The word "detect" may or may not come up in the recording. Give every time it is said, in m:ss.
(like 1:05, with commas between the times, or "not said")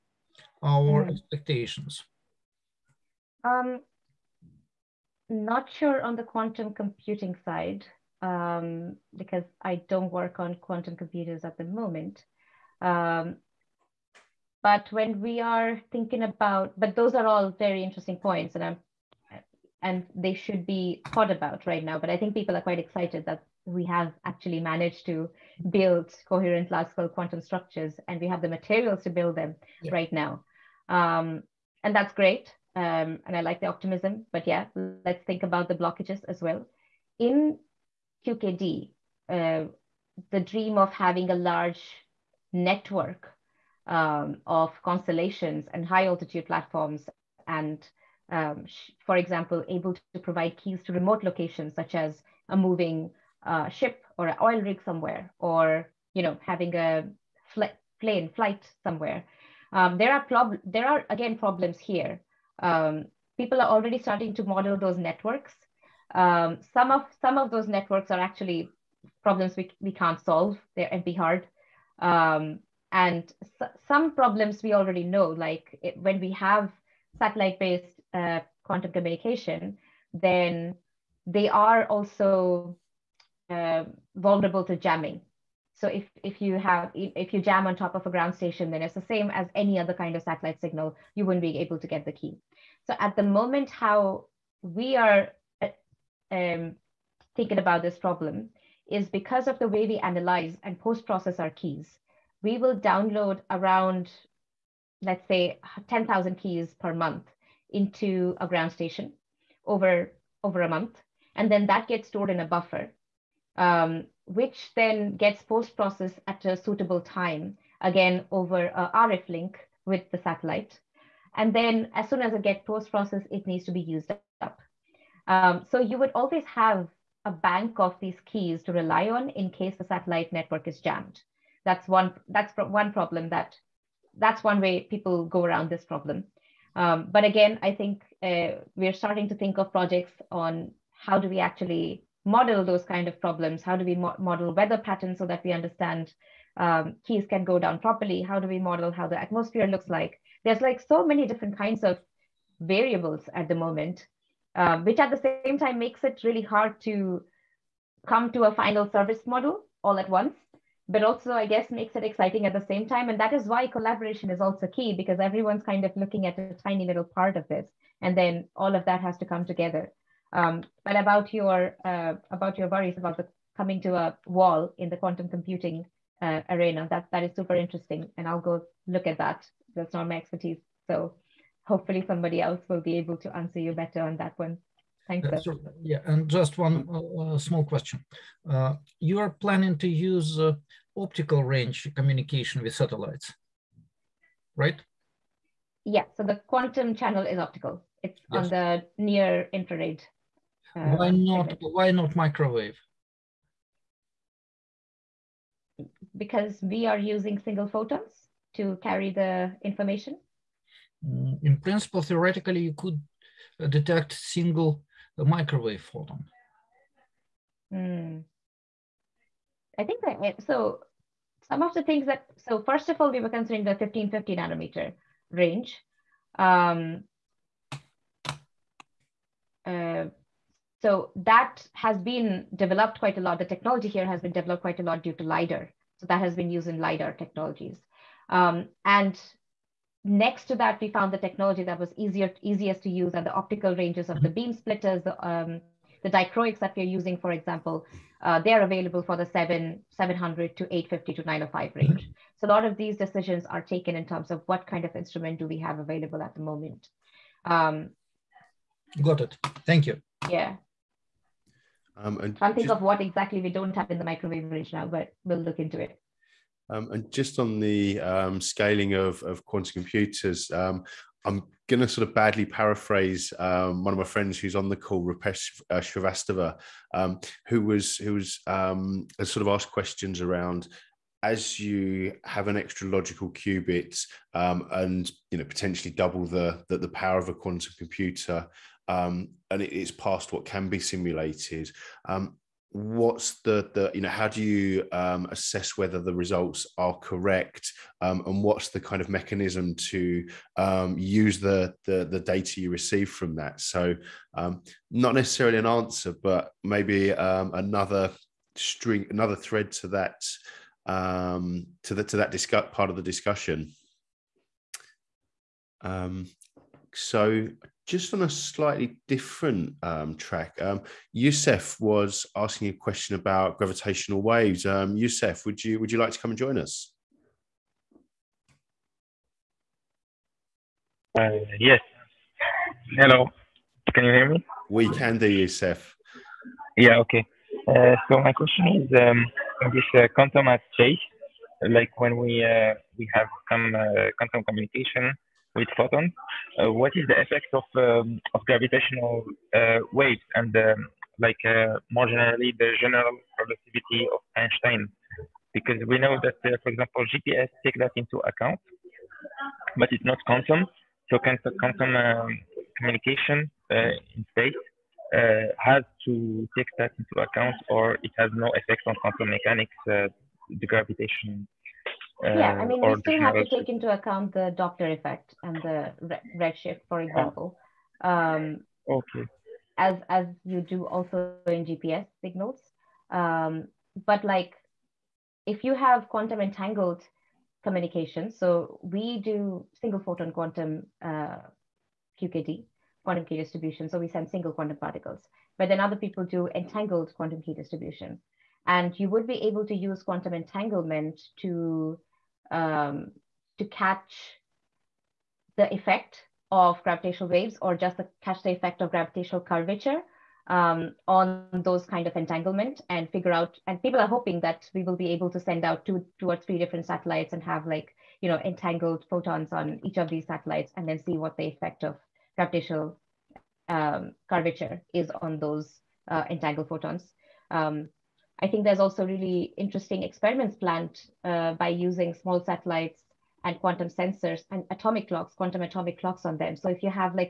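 3:33.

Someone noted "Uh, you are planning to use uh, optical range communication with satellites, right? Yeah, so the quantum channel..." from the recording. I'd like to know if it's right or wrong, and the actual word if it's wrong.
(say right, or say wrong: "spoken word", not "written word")
right.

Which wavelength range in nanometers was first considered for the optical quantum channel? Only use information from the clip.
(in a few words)
1550 nanometers.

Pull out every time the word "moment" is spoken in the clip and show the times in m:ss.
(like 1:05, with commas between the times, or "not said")
0:11, 1:33, 2:33, 4:16.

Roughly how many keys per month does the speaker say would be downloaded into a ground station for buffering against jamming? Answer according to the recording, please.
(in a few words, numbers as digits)
10,000.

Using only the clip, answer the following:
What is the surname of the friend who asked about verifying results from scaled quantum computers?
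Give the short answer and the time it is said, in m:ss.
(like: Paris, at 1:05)
Shrivastava, at 4:35.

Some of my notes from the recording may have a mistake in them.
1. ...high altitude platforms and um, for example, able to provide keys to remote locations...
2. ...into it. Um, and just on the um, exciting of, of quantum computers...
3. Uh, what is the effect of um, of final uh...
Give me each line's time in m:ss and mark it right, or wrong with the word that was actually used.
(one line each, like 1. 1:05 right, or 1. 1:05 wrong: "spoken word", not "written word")
1. 0:45 right
2. 4:25 wrong: "scaling", not "exciting"
3. 5:46 wrong: "gravitational", not "final".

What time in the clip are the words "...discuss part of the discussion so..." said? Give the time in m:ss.
5:12.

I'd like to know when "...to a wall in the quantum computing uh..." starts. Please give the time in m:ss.
2:53.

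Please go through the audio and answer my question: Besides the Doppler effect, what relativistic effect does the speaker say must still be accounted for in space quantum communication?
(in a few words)
Redshift.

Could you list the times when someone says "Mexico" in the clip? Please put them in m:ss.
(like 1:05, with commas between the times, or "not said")
not said.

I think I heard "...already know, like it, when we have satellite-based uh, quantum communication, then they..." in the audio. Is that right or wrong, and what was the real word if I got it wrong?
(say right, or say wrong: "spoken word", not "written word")
right.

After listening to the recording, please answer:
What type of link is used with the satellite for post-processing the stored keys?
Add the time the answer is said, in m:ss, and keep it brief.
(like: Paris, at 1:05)
RF link, at 1:58.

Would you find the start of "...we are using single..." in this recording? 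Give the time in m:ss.
3:26.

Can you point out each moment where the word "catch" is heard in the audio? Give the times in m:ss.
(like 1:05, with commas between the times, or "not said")
6:43, 6:48.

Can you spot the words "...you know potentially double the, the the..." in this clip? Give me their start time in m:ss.
4:45.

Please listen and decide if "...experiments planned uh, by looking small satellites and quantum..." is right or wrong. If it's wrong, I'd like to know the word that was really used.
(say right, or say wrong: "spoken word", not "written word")
wrong: "using", not "looking".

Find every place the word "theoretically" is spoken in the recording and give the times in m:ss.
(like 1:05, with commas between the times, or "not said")
3:32.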